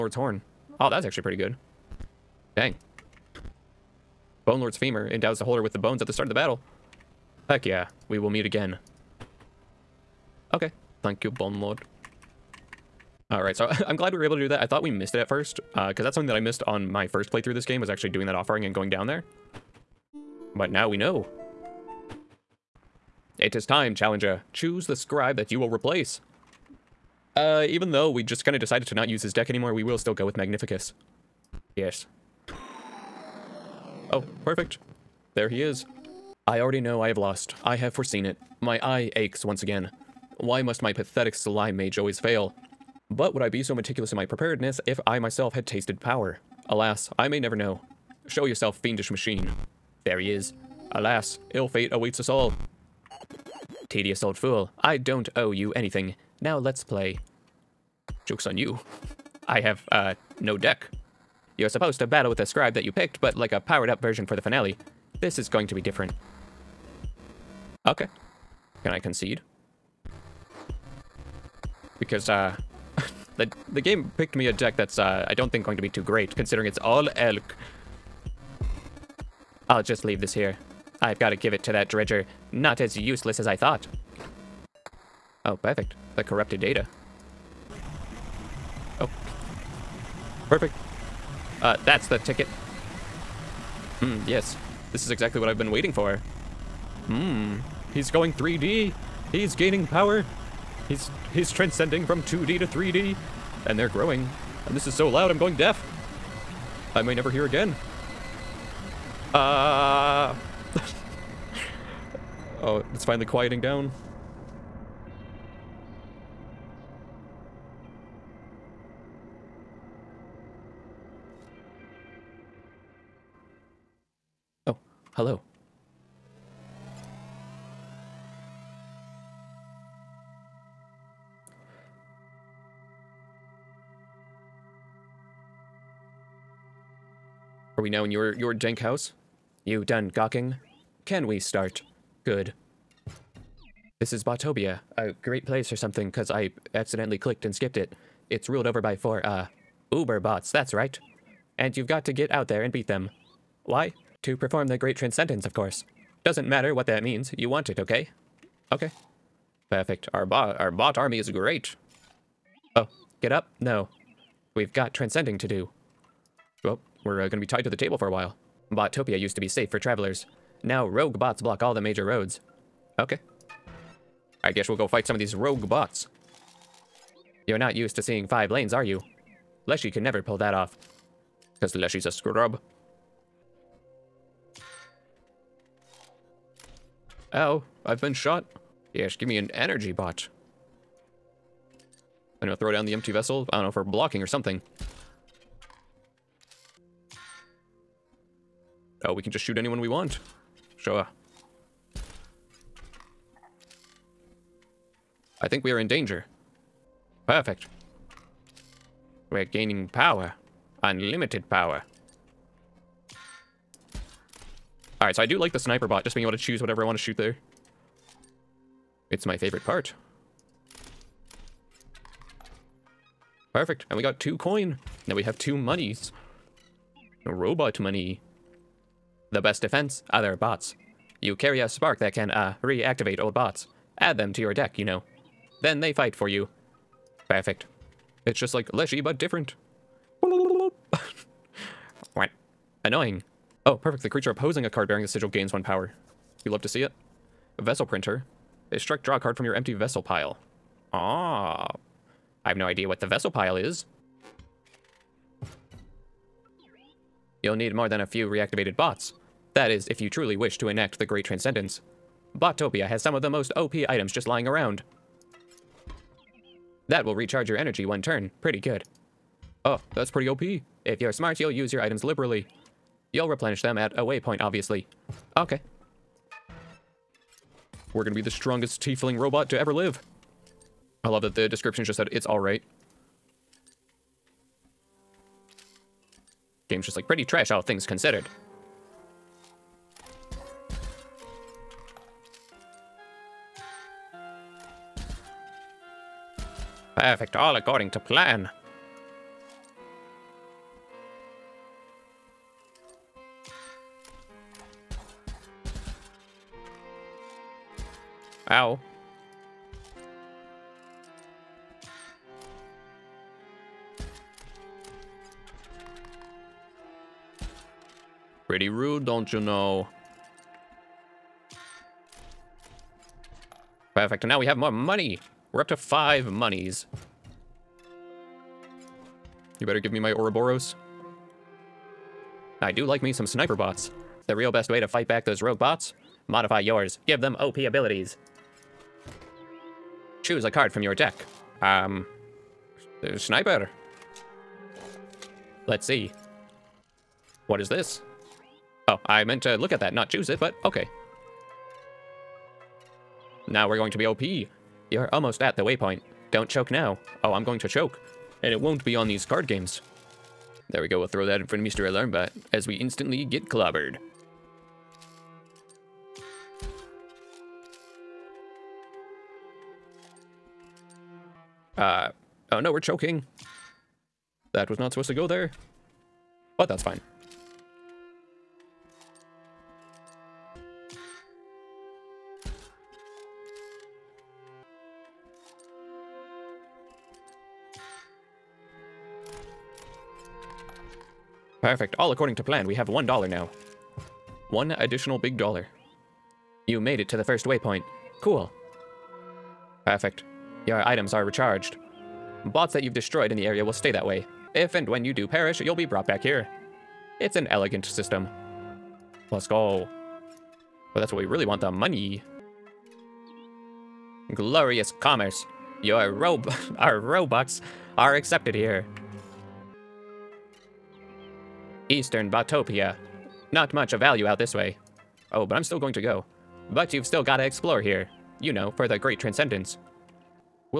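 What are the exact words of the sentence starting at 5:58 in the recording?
And it won't be on these card games.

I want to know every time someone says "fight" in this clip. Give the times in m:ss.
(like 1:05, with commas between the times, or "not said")
2:54, 3:55, 5:34.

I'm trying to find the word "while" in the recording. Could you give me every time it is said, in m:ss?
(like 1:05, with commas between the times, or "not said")
2:48.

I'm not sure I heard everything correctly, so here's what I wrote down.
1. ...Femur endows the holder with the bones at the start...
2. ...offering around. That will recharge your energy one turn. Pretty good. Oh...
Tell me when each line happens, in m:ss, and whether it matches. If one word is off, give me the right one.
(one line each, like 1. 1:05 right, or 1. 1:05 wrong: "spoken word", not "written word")
1. 0:04 right
2. 4:24 wrong: "lying", not "offering".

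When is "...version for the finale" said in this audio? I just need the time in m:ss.
1:04.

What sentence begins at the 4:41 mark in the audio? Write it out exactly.
I love that the description just said, it's alright.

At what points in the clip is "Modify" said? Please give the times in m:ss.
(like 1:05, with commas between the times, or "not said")
5:36.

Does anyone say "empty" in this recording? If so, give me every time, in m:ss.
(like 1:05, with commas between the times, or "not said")
3:12, 4:09.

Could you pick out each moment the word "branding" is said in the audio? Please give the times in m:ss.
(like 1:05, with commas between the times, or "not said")
not said.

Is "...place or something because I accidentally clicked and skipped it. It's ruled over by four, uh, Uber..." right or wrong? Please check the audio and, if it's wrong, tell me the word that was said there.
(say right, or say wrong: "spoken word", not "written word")
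right.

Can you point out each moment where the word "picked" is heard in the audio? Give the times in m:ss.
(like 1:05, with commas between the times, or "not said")
1:02, 1:14.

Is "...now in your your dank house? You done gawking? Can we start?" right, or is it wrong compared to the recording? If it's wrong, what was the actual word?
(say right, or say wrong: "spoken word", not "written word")
right.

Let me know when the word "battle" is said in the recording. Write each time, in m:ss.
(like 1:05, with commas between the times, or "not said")
0:06, 1:02.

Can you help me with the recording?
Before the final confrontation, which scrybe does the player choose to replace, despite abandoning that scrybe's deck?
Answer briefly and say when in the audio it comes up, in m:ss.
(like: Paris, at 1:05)
Magnificus, at 0:30.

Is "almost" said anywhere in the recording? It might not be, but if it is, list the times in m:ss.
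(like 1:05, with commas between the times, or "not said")
5:55.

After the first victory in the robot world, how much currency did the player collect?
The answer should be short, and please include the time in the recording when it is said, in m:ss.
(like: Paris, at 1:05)
2 coins, at 3:44.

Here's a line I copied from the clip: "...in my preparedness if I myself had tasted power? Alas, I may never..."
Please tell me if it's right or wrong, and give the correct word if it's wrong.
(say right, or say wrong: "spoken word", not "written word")
right.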